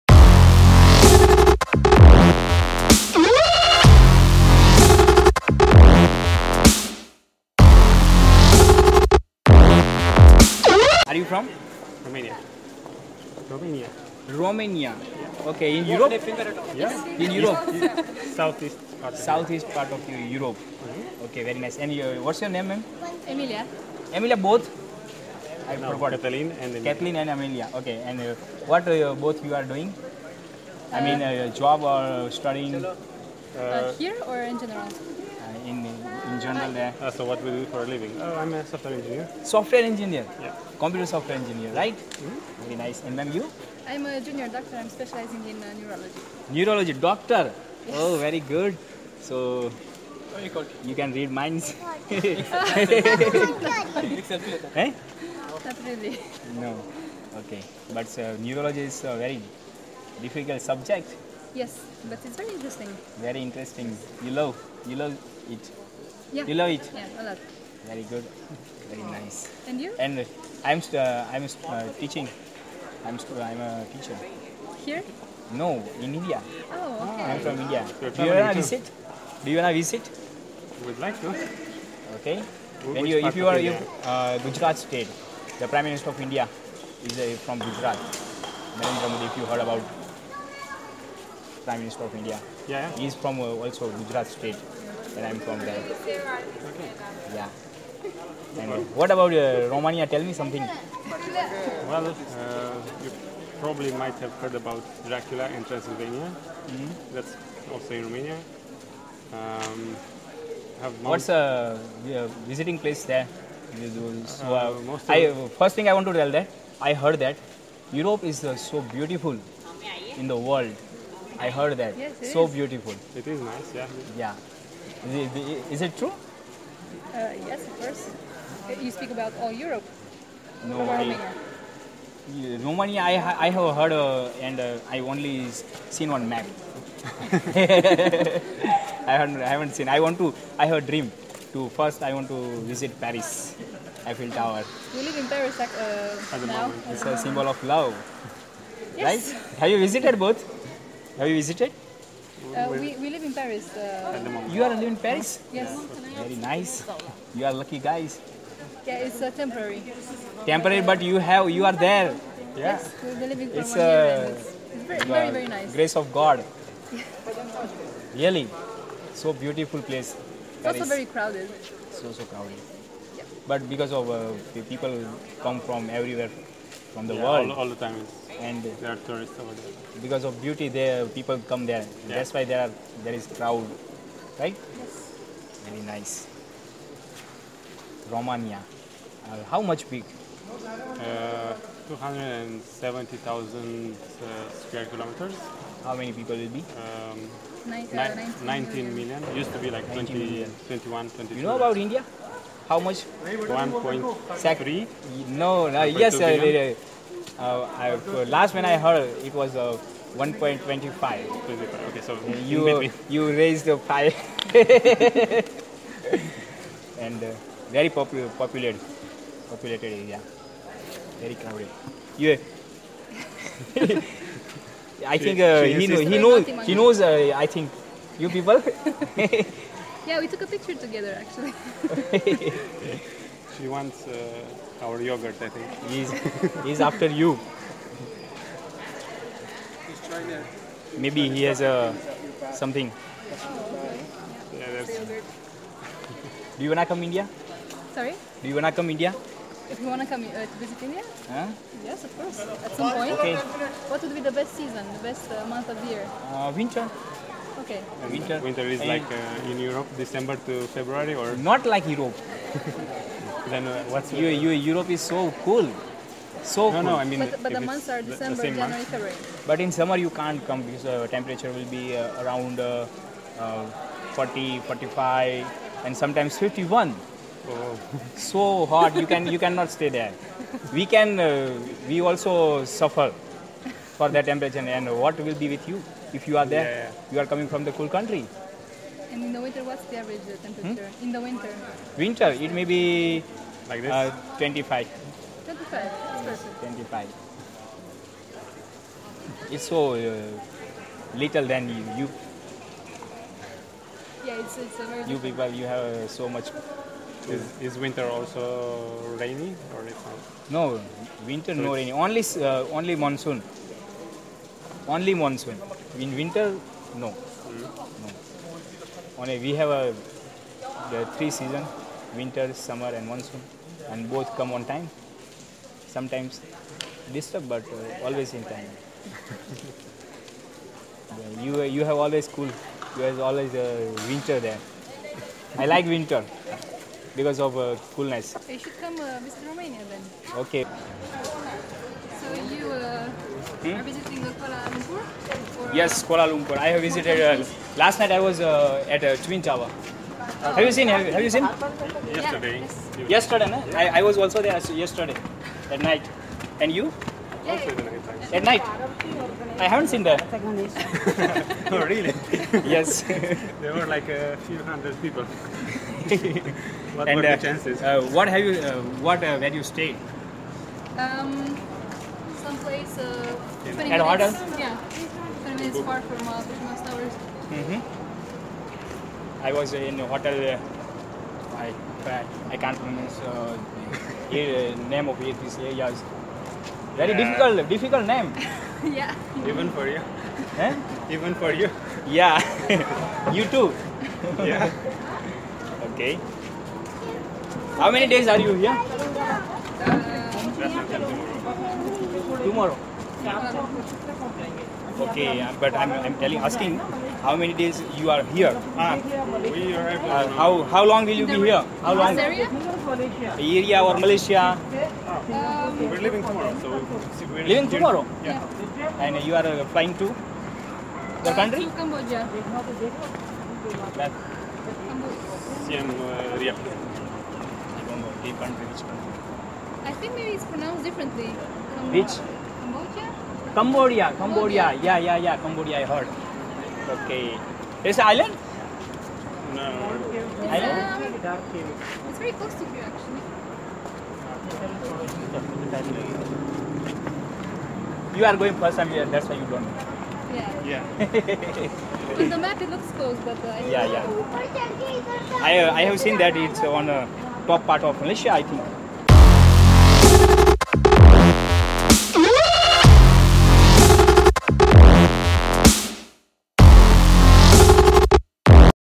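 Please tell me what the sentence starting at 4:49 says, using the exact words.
And in the winter, what's the average uh, temperature?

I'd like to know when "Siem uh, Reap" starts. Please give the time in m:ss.
7:05.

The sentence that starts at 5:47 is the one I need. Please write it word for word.
last night I was at Twin Tower.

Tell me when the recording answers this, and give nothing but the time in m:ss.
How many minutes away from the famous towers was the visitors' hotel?
6:15.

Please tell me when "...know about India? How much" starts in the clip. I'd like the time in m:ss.
3:21.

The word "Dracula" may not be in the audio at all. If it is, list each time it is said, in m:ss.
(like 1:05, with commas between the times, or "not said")
1:45.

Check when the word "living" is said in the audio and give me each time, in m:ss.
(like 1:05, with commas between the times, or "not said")
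0:37, 2:34, 2:43.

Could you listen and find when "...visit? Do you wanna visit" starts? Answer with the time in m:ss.
1:18.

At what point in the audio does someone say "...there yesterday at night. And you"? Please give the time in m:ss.
5:54.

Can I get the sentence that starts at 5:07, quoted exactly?
Is, is winter also rainy or it's not?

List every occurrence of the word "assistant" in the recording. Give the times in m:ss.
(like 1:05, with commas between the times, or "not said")
not said.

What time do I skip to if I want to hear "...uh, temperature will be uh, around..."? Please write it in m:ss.
4:30.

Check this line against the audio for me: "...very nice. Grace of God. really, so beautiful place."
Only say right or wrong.
right.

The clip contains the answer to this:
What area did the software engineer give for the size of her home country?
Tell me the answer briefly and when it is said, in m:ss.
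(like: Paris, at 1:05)
270,000 square kilometers, at 3:11.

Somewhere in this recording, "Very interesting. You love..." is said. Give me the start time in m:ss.
1:03.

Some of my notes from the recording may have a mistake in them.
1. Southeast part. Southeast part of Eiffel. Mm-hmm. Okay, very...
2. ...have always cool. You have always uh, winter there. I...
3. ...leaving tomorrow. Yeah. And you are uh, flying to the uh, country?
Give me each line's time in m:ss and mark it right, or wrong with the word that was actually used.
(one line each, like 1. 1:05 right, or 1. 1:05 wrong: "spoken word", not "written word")
1. 0:18 wrong: "Europe", not "Eiffel"
2. 5:31 right
3. 6:57 right.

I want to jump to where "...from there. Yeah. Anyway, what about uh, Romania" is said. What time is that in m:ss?
1:35.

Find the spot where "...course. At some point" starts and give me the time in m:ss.
4:12.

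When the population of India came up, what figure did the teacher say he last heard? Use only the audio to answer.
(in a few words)
1.25 billion.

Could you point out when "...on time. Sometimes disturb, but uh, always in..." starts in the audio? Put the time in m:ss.
5:24.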